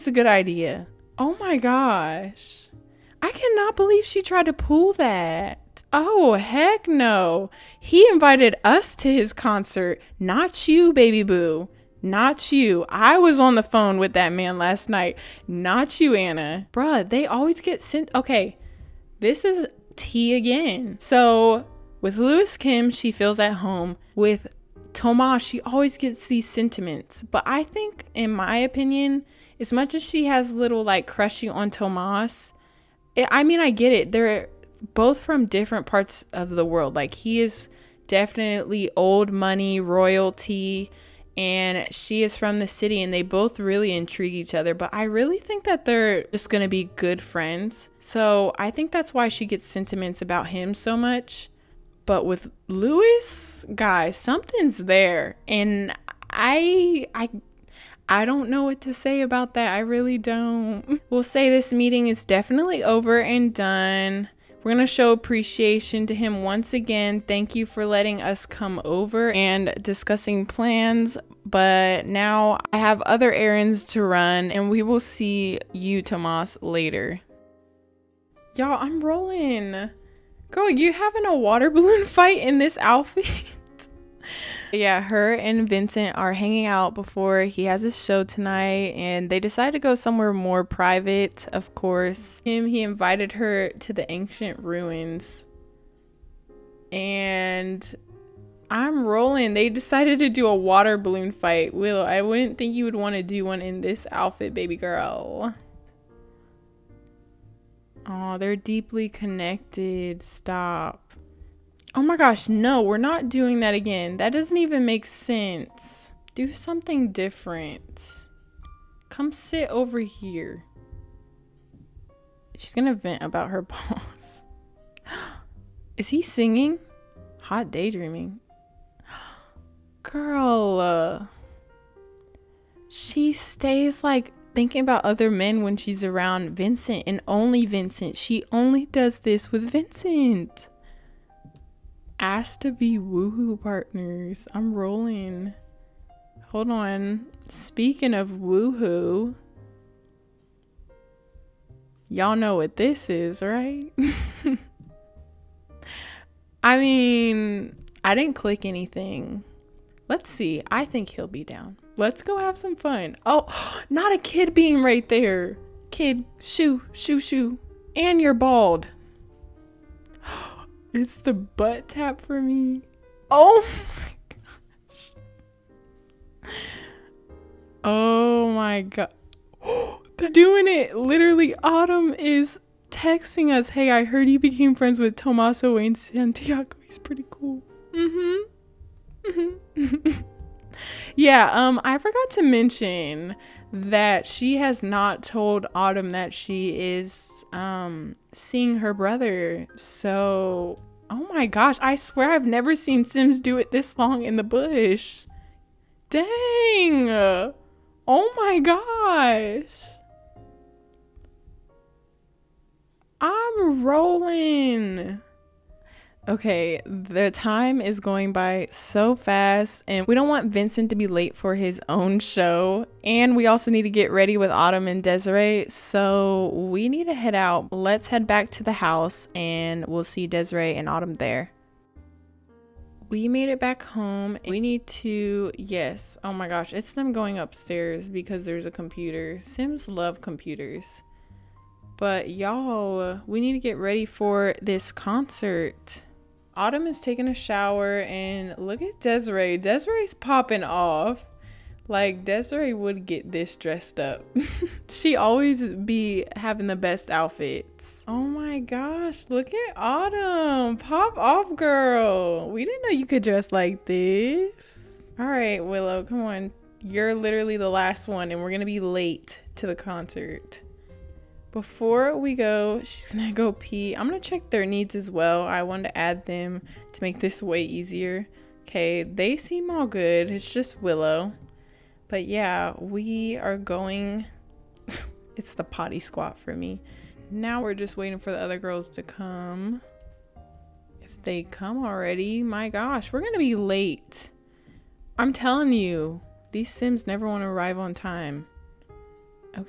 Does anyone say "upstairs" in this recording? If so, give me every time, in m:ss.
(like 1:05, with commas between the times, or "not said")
3:57.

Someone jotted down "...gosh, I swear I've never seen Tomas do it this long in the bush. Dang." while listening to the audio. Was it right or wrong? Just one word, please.
wrong.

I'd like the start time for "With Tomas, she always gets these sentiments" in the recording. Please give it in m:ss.
0:24.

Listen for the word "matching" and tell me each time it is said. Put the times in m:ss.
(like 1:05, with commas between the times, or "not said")
not said.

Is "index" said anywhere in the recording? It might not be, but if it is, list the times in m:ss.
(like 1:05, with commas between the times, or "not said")
not said.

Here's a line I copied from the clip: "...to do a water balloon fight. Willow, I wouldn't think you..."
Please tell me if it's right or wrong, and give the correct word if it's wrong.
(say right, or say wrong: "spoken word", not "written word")
right.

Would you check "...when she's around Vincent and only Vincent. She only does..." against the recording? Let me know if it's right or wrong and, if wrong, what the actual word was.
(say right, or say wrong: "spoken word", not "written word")
right.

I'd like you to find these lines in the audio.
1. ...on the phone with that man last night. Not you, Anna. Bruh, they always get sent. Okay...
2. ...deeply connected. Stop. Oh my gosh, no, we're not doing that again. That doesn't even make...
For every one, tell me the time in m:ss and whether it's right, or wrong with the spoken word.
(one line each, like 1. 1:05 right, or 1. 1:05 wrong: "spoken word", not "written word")
1. 0:13 right
2. 1:48 right.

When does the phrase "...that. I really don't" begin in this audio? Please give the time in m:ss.
0:59.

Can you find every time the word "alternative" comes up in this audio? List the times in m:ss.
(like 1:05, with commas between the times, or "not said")
not said.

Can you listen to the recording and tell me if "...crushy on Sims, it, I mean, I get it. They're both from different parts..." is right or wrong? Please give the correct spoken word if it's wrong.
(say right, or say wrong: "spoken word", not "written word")
wrong: "Tomas", not "Sims".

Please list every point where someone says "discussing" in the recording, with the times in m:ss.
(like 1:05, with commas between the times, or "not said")
1:09.